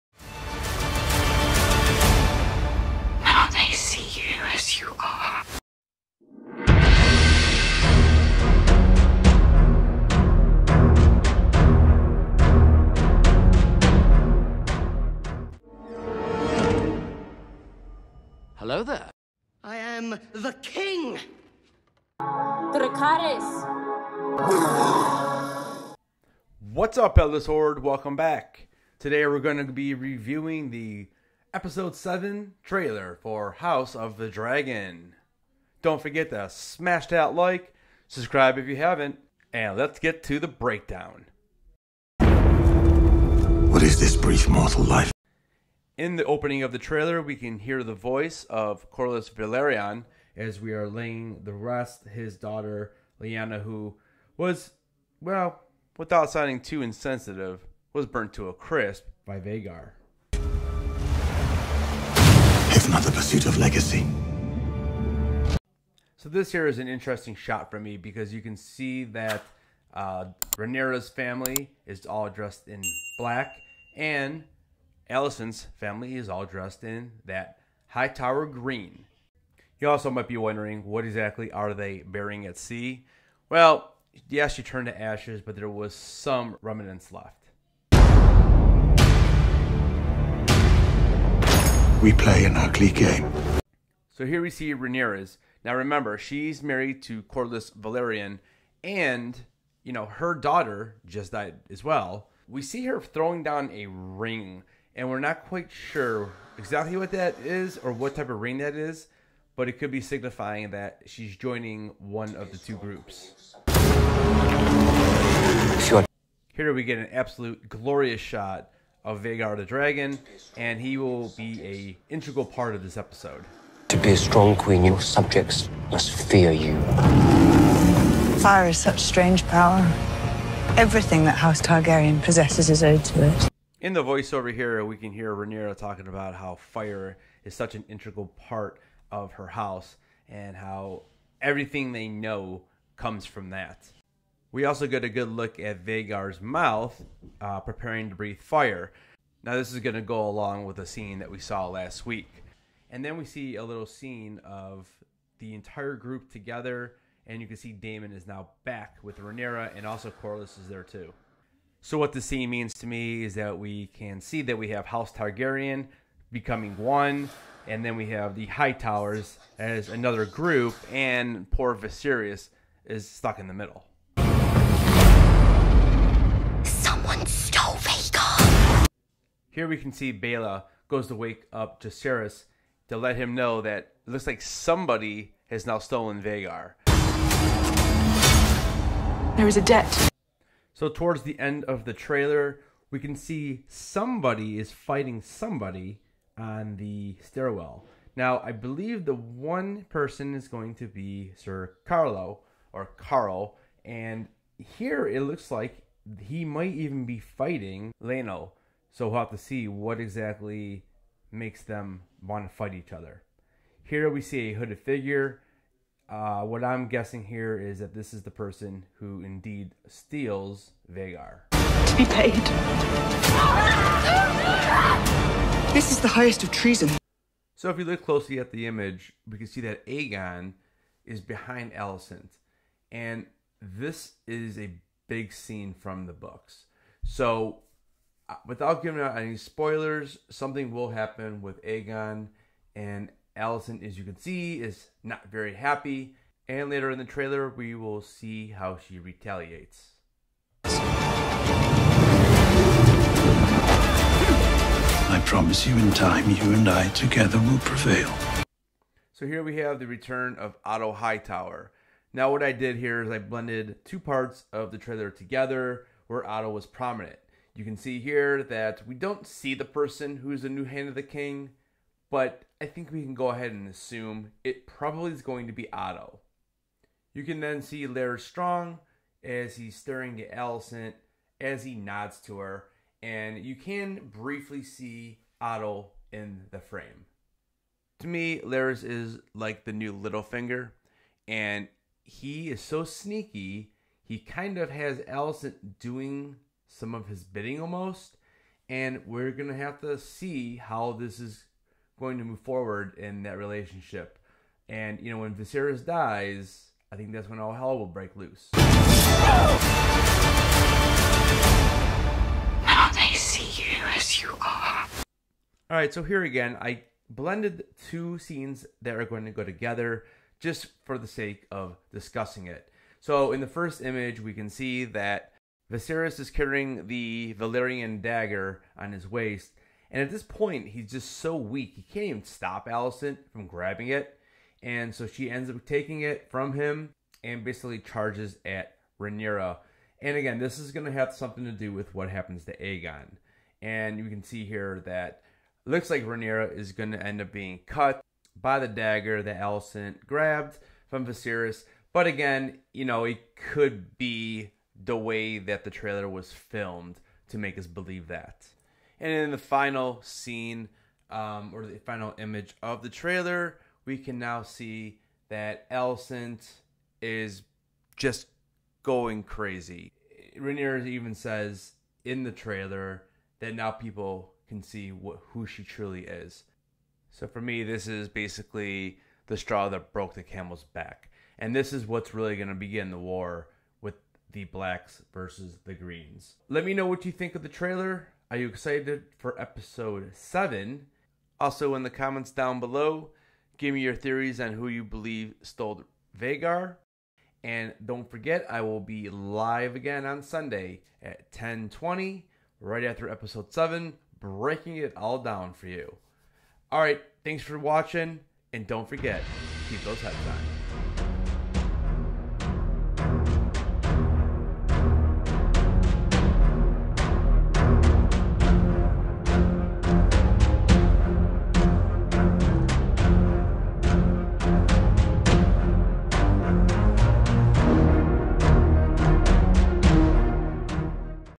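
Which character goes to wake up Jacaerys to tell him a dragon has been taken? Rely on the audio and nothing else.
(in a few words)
Baela.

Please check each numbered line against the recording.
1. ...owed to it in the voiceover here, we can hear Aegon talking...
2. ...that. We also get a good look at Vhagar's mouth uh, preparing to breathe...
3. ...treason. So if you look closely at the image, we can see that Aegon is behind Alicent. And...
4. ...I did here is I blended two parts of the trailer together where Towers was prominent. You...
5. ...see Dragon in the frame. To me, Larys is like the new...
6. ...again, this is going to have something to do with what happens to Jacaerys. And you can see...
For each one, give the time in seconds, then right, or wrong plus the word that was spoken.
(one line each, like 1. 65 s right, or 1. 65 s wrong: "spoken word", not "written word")
1. 132 s wrong: "Rhaenyra", not "Aegon"
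2. 143 s right
3. 226 s right
4. 262 s wrong: "Otto", not "Towers"
5. 284 s wrong: "Otto", not "Dragon"
6. 340 s wrong: "Aegon", not "Jacaerys".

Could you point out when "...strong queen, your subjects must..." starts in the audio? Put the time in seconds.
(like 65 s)
124 s.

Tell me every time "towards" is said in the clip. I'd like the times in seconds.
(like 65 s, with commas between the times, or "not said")
190 s.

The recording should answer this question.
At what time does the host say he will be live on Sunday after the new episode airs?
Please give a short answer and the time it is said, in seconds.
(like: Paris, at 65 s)
10:20, at 401 s.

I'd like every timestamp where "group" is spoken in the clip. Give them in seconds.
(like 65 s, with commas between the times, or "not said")
112 s, 155 s, 170 s.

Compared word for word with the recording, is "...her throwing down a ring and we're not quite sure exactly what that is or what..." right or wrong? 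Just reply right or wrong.
right.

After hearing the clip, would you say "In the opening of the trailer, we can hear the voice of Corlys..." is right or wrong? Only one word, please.
right.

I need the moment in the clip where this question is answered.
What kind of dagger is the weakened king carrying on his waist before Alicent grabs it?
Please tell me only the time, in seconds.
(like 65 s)
327 s.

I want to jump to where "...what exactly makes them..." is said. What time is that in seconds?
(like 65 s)
209 s.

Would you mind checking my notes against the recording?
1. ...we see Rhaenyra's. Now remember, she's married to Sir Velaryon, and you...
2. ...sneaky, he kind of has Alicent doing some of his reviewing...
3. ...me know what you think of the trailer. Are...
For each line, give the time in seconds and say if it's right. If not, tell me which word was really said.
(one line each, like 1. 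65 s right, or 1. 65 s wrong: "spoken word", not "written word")
1. 94 s wrong: "Corlys", not "Sir"
2. 292 s wrong: "bidding", not "reviewing"
3. 386 s right.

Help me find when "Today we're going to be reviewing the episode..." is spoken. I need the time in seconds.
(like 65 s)
28 s.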